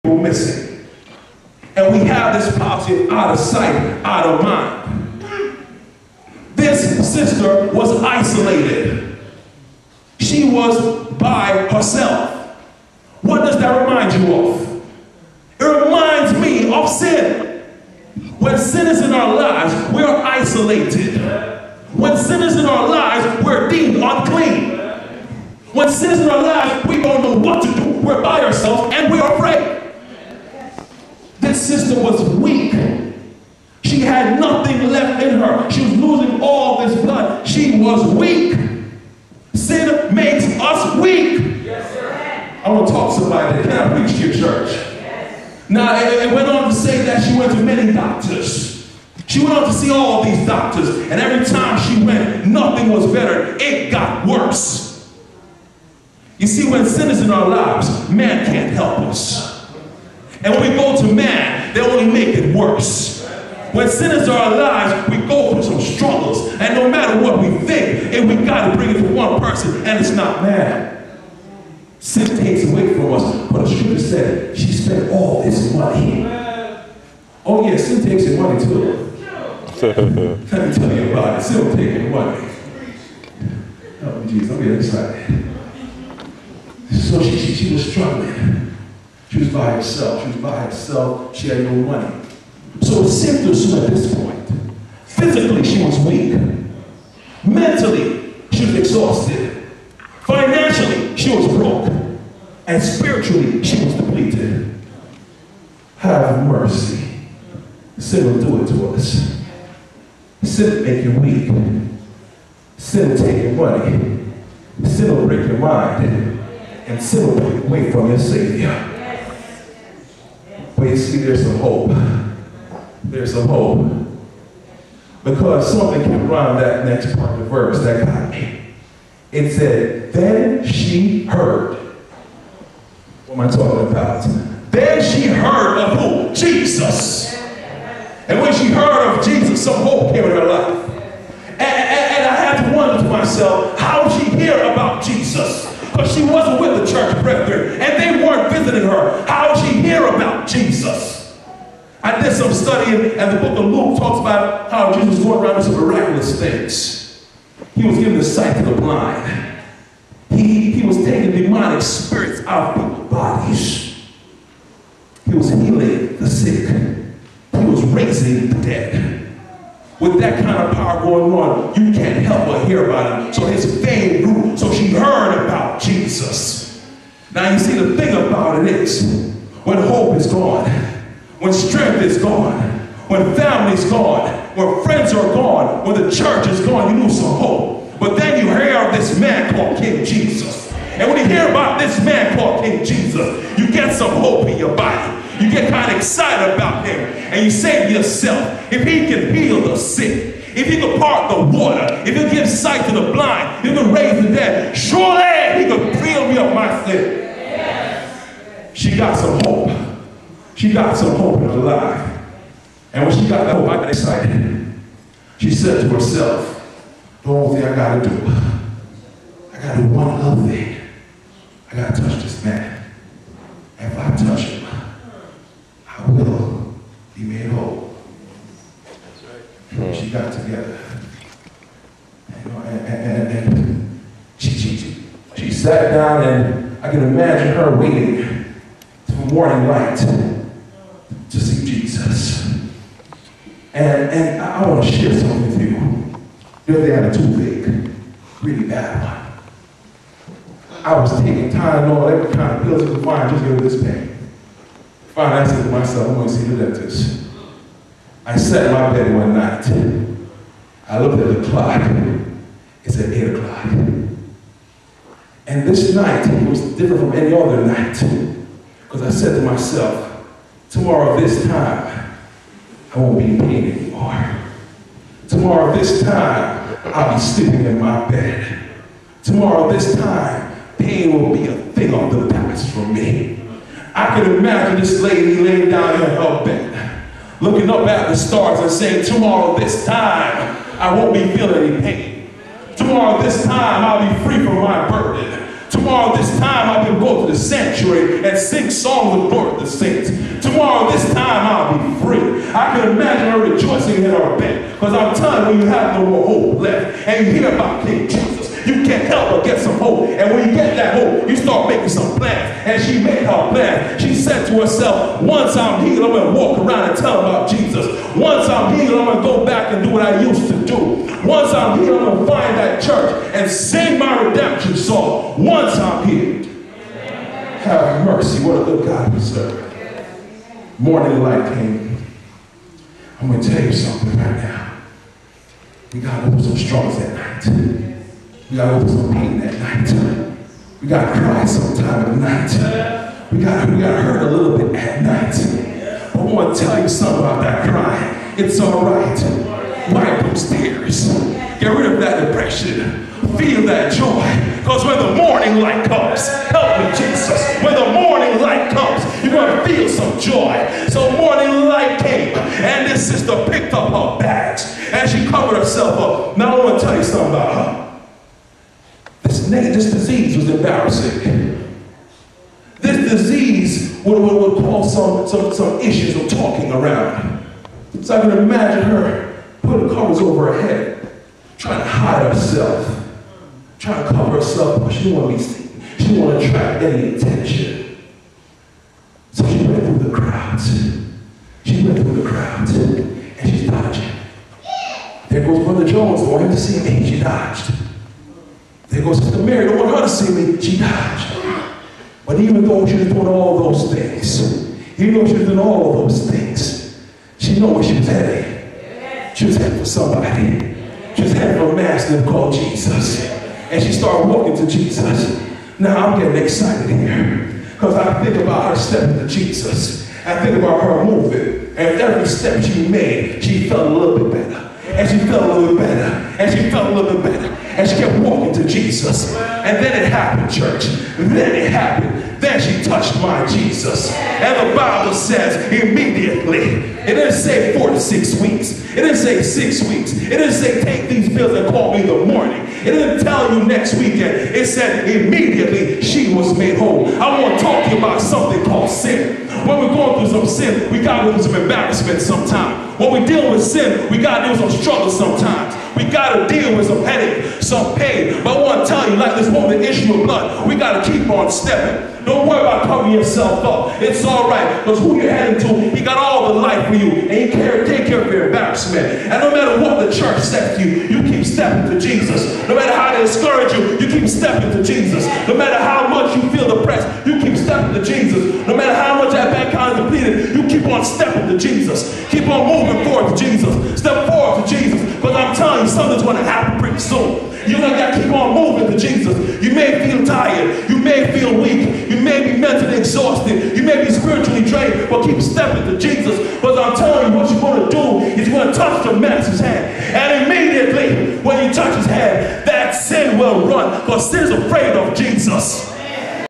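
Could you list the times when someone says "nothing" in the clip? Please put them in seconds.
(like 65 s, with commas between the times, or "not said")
34 s, 52 s.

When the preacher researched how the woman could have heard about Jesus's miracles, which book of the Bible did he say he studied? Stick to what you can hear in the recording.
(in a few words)
Luke.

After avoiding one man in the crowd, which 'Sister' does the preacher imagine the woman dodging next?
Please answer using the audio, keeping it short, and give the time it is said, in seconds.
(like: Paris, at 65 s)
Sister Mary, at 399 s.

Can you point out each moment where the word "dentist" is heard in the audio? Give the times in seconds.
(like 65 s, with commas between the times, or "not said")
256 s.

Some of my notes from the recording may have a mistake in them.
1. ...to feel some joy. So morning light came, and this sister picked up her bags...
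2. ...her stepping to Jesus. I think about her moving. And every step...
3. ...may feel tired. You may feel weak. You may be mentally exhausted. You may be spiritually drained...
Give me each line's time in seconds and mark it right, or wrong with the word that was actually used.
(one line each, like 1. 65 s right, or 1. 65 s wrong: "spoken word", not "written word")
1. 359 s right
2. 418 s right
3. 489 s right.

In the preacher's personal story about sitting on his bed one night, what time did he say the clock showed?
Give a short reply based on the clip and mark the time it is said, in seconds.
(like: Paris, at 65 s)
8 o'clock, at 263 s.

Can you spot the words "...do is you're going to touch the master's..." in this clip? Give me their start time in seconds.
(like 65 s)
497 s.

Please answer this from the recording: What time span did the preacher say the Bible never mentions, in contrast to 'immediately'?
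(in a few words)
4 to 6 weeks.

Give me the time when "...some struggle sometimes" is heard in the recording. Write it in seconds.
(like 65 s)
454 s.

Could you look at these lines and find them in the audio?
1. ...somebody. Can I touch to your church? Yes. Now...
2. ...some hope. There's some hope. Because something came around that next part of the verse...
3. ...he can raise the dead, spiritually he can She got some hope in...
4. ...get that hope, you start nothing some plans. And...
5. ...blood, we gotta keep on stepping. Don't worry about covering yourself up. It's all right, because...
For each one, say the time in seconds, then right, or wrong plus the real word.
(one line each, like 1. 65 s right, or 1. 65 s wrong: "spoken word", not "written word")
1. 43 s wrong: "preach", not "touch"
2. 121 s right
3. 203 s wrong: "surely", not "spiritually"
4. 310 s wrong: "making", not "nothing"
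5. 460 s right.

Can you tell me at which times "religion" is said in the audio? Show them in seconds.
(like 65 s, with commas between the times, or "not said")
not said.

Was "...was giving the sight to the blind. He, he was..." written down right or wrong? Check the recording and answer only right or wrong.
right.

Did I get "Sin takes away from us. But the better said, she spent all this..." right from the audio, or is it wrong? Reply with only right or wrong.
wrong.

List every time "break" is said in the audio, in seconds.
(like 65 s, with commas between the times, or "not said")
115 s.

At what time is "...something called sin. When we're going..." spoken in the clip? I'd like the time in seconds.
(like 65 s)
448 s.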